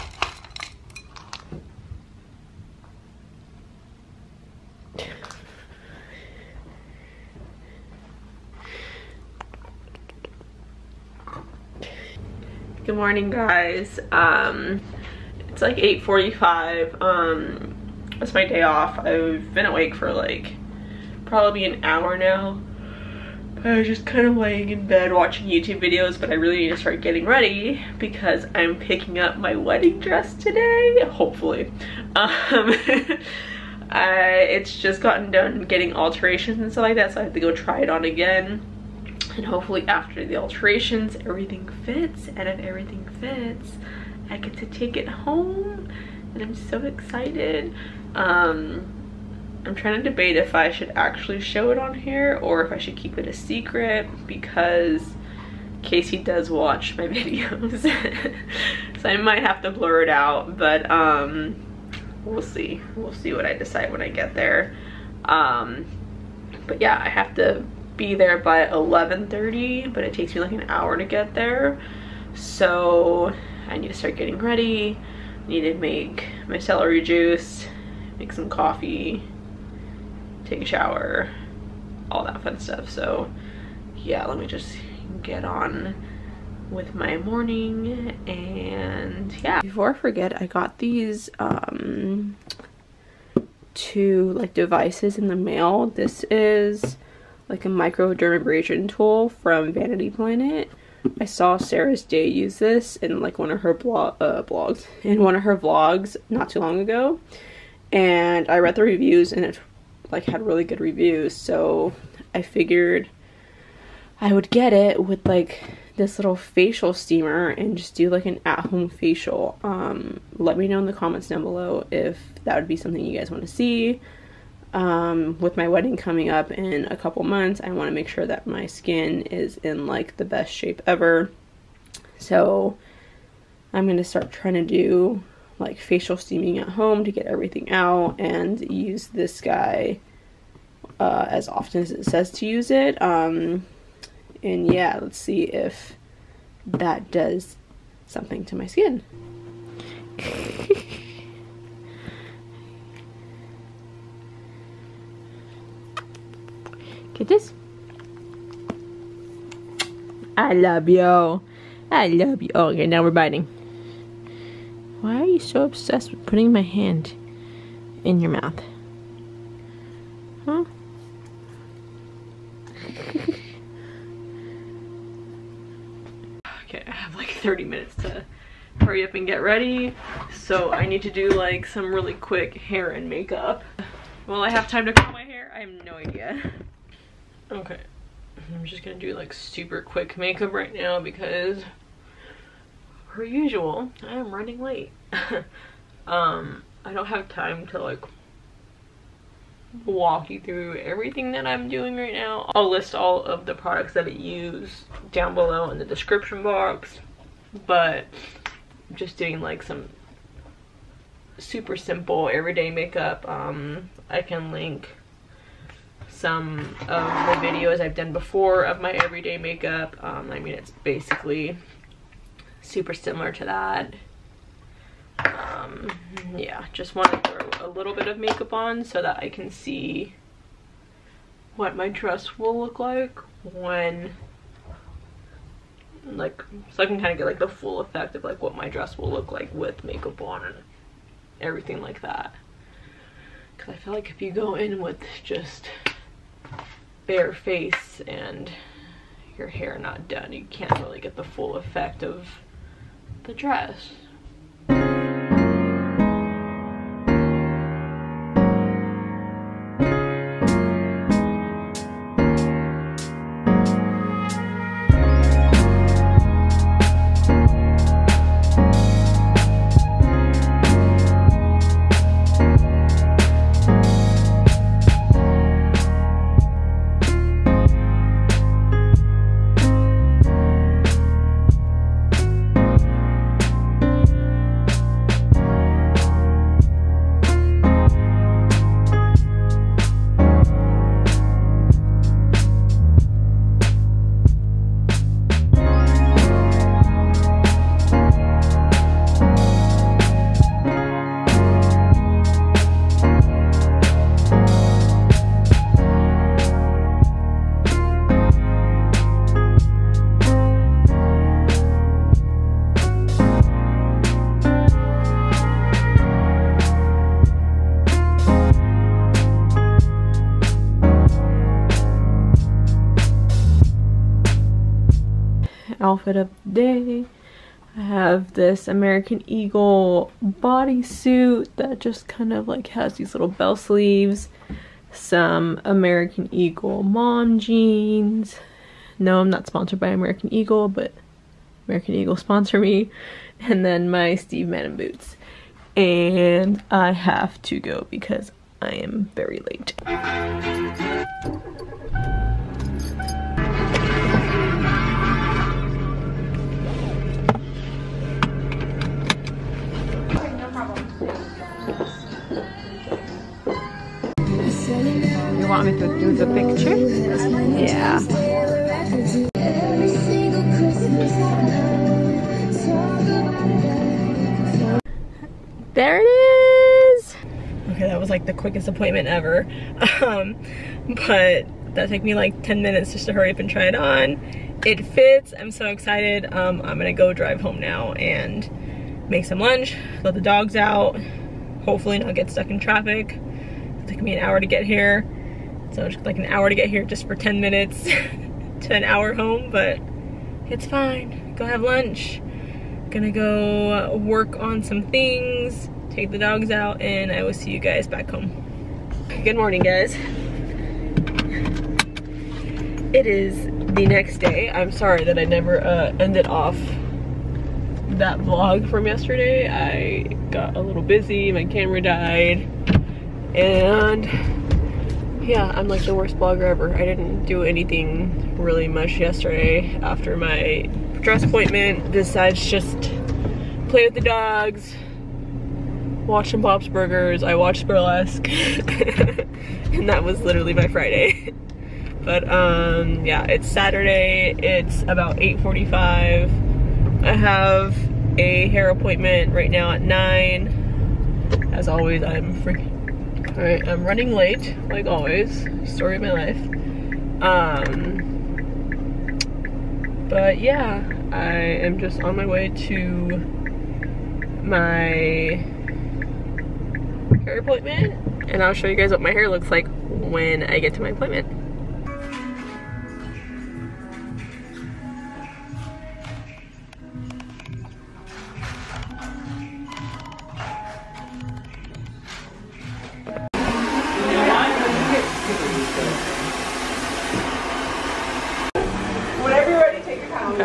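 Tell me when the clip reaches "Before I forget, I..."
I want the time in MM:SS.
01:29.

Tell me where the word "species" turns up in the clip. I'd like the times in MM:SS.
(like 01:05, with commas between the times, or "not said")
not said.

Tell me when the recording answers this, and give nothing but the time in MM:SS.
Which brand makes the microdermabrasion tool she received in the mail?
01:39.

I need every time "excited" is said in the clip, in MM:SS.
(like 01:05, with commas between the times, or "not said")
00:46, 06:25.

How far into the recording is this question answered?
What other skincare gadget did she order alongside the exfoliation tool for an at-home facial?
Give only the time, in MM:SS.
01:56.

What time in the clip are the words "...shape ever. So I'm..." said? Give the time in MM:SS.
02:10.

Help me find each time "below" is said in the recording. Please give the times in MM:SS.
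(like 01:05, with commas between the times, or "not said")
02:01, 03:25.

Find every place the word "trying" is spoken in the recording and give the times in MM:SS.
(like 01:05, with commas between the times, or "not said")
00:49, 02:14.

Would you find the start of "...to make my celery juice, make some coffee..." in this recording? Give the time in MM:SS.
01:15.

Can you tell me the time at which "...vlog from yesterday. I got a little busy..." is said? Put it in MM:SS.
06:58.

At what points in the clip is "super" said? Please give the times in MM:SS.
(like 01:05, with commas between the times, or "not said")
03:09, 03:31, 03:42.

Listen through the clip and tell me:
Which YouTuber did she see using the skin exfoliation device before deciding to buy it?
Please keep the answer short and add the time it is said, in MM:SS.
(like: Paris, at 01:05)
Sarah's Day, at 01:41.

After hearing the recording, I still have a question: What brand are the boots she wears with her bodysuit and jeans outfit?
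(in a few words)
Steve Madden.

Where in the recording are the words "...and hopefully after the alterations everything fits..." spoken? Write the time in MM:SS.
00:39.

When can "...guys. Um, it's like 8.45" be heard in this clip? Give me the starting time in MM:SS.
00:13.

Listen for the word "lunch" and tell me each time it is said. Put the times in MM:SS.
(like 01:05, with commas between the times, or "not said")
06:29, 06:41.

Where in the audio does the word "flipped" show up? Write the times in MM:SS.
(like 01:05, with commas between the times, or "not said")
not said.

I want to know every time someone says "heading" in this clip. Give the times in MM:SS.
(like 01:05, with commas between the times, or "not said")
not said.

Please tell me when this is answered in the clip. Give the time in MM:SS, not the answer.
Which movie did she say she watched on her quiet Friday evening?
07:17.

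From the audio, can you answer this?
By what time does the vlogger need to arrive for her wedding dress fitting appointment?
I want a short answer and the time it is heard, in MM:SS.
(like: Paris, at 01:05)
11:30, at 01:08.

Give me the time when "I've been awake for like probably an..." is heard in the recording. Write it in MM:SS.
00:18.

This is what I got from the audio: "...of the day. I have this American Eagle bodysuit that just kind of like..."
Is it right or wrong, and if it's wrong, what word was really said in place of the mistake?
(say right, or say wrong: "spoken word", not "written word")
right.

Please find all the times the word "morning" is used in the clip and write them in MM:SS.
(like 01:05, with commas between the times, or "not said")
00:13, 01:27, 06:49.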